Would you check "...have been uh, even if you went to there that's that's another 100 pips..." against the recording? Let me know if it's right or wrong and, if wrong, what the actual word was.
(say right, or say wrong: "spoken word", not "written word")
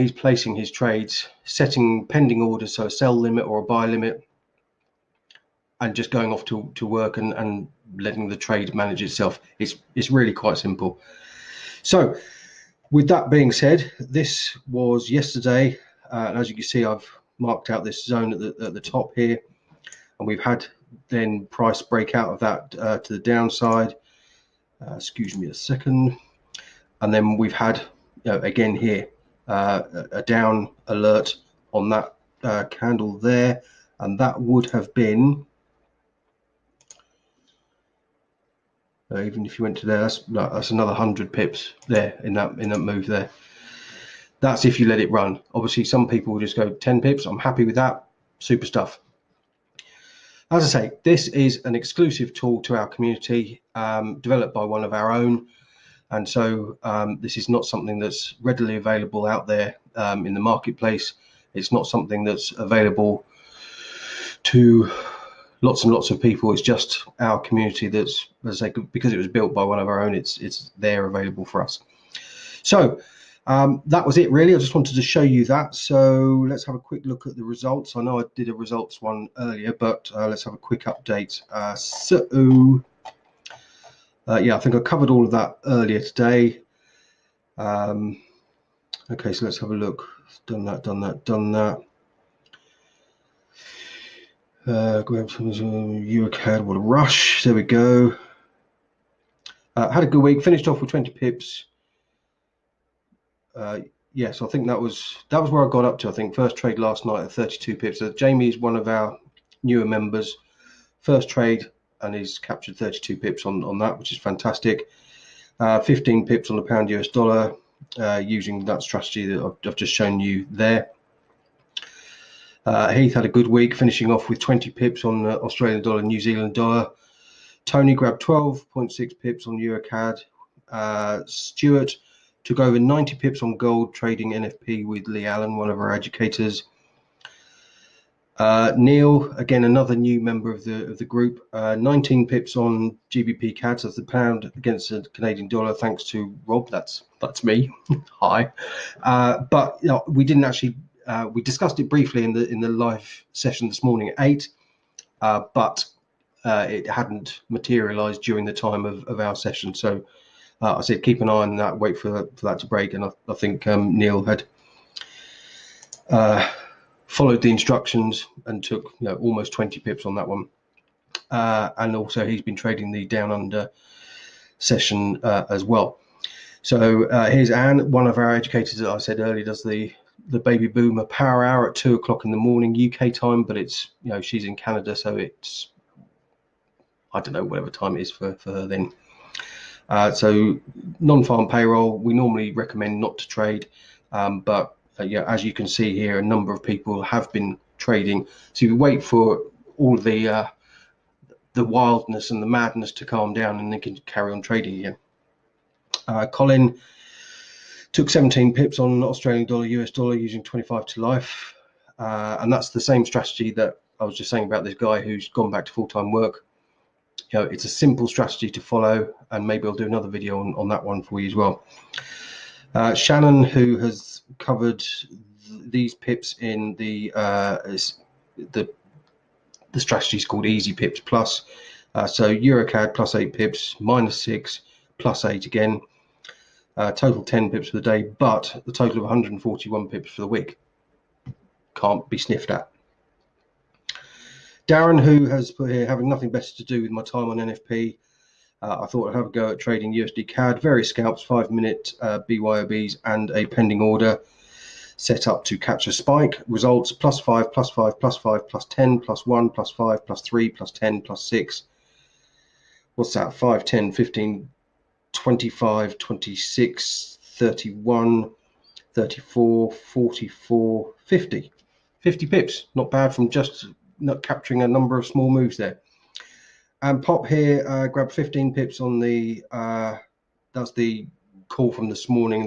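right.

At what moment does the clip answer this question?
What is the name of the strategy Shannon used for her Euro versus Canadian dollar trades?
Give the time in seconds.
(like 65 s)
230 s.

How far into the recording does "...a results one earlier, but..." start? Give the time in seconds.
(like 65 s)
78 s.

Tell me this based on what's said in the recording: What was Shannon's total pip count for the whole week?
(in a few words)
141.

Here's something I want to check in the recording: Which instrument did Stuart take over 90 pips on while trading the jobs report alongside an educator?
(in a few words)
Gold.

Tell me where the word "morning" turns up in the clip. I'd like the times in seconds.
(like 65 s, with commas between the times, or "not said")
153 s, 182 s.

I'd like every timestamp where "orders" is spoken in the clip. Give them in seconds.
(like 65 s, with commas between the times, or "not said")
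2 s, 253 s.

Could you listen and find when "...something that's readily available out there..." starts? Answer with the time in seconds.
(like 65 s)
57 s.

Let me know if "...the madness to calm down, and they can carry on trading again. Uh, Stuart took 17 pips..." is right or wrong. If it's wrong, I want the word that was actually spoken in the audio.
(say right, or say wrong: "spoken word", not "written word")
wrong: "Colin", not "Stuart".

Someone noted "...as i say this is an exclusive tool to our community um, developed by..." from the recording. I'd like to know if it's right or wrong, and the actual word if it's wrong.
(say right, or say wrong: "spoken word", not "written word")
right.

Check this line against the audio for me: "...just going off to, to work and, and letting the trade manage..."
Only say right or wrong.
right.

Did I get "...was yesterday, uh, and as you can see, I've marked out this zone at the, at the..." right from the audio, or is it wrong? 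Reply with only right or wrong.
right.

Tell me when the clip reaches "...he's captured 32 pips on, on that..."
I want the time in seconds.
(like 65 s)
112 s.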